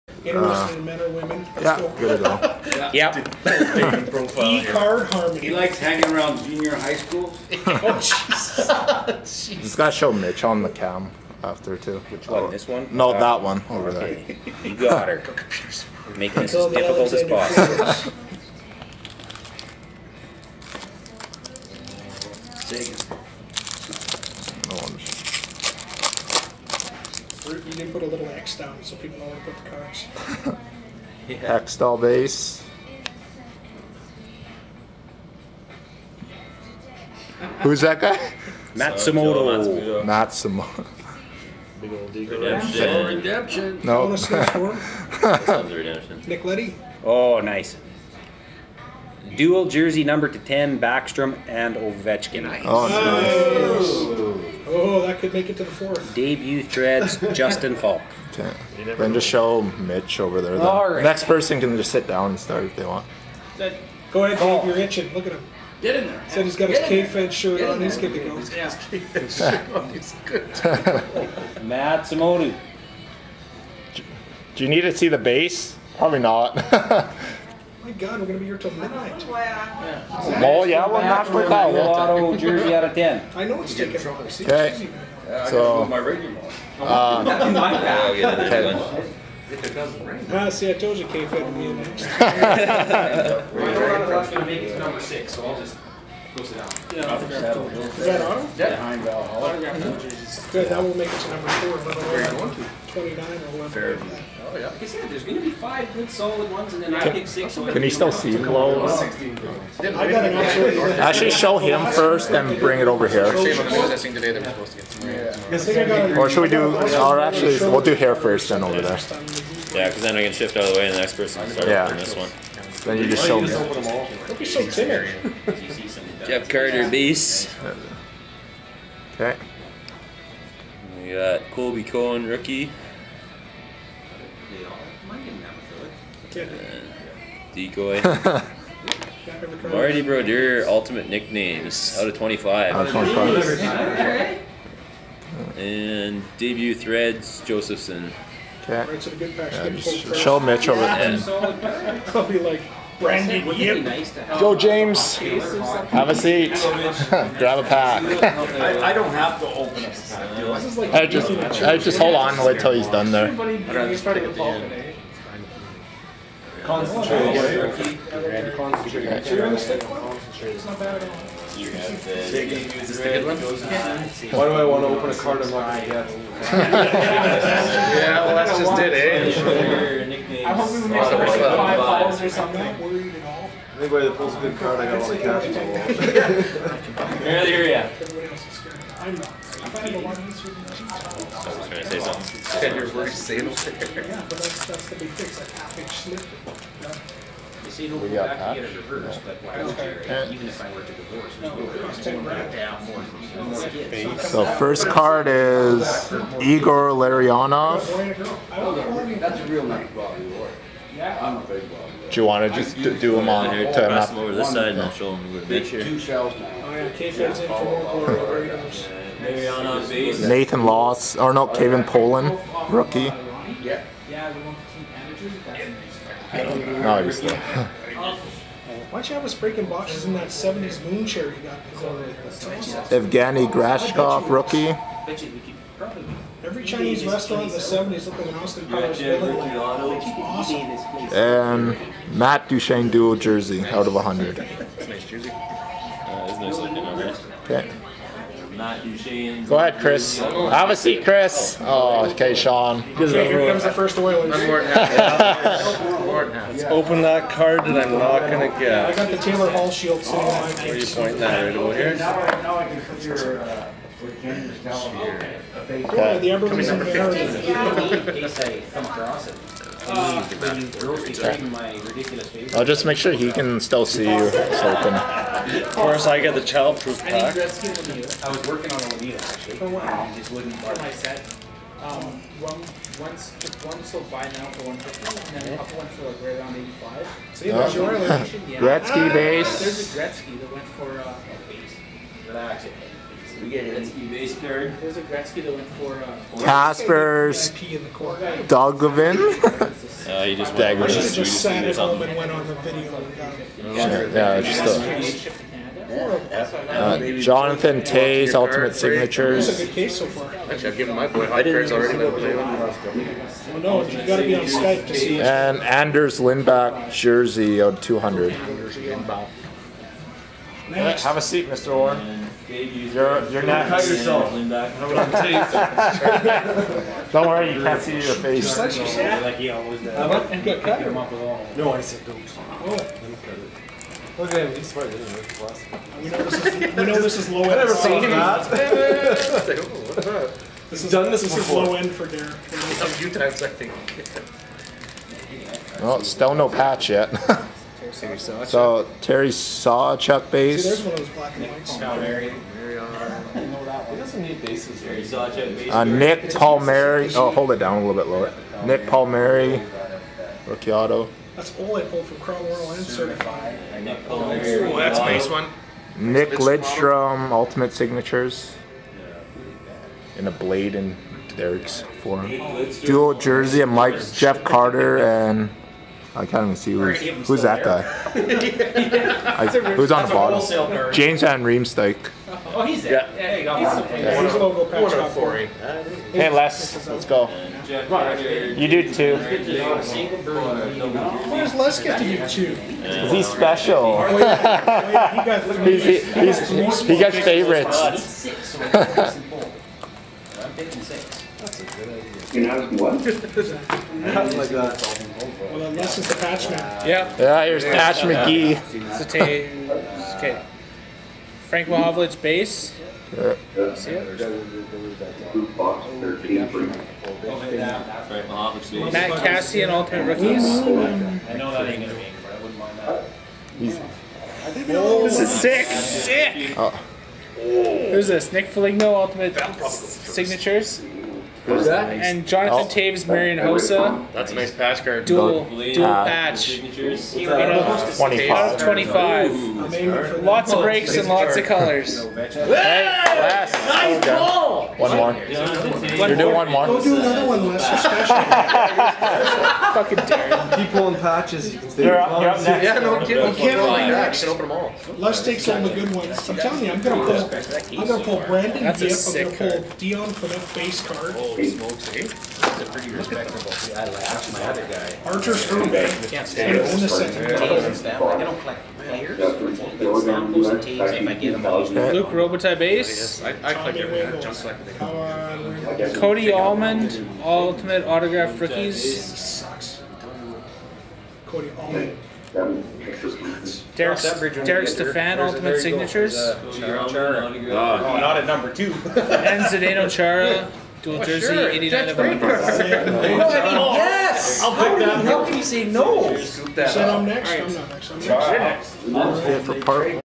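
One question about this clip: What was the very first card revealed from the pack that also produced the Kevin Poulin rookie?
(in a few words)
Igor Larionov.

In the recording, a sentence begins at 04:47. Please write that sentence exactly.
So you have your location, yeah.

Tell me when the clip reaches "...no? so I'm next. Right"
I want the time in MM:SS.
08:15.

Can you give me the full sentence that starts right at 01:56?
Or should we do, or actually, we'll do hair first, then over there.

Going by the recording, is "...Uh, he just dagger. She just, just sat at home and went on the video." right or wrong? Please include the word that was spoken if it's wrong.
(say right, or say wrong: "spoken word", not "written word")
right.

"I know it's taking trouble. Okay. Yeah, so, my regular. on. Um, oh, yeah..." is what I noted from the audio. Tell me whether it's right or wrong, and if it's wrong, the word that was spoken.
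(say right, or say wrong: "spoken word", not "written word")
right.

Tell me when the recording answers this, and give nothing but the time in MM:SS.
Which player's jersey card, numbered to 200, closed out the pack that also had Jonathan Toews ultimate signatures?
05:15.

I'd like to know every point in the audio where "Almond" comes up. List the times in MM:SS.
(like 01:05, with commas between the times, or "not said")
07:56, 08:01.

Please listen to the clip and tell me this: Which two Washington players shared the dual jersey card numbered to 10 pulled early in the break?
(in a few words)
Backstrom and Ovechkin.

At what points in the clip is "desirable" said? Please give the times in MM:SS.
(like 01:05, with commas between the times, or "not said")
not said.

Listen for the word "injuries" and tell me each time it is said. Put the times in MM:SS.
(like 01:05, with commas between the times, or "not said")
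not said.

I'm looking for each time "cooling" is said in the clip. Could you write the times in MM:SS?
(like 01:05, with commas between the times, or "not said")
not said.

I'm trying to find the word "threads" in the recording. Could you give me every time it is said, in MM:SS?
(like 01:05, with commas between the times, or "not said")
00:56, 02:26.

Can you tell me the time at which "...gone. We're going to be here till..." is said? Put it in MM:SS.
01:18.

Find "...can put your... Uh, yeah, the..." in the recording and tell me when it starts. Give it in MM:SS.
04:22.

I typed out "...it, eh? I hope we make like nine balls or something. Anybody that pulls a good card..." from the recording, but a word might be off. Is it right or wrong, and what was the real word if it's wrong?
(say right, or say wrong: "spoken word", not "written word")
wrong: "five", not "nine".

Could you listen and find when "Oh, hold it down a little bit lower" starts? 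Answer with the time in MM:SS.
05:57.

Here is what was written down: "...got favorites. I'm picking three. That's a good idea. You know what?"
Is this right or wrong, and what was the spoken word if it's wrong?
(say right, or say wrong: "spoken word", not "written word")
wrong: "six", not "three".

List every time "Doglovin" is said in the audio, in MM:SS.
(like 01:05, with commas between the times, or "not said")
04:57.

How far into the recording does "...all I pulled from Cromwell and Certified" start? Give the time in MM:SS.
06:01.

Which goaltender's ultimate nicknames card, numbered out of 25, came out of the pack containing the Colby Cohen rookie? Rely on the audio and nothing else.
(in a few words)
Marty Brodeur.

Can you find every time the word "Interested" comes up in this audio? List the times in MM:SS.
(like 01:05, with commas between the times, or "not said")
00:00.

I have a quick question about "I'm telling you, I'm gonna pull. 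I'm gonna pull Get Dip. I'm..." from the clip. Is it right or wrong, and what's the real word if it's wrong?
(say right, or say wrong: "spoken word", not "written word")
wrong: "Brandon", not "Get".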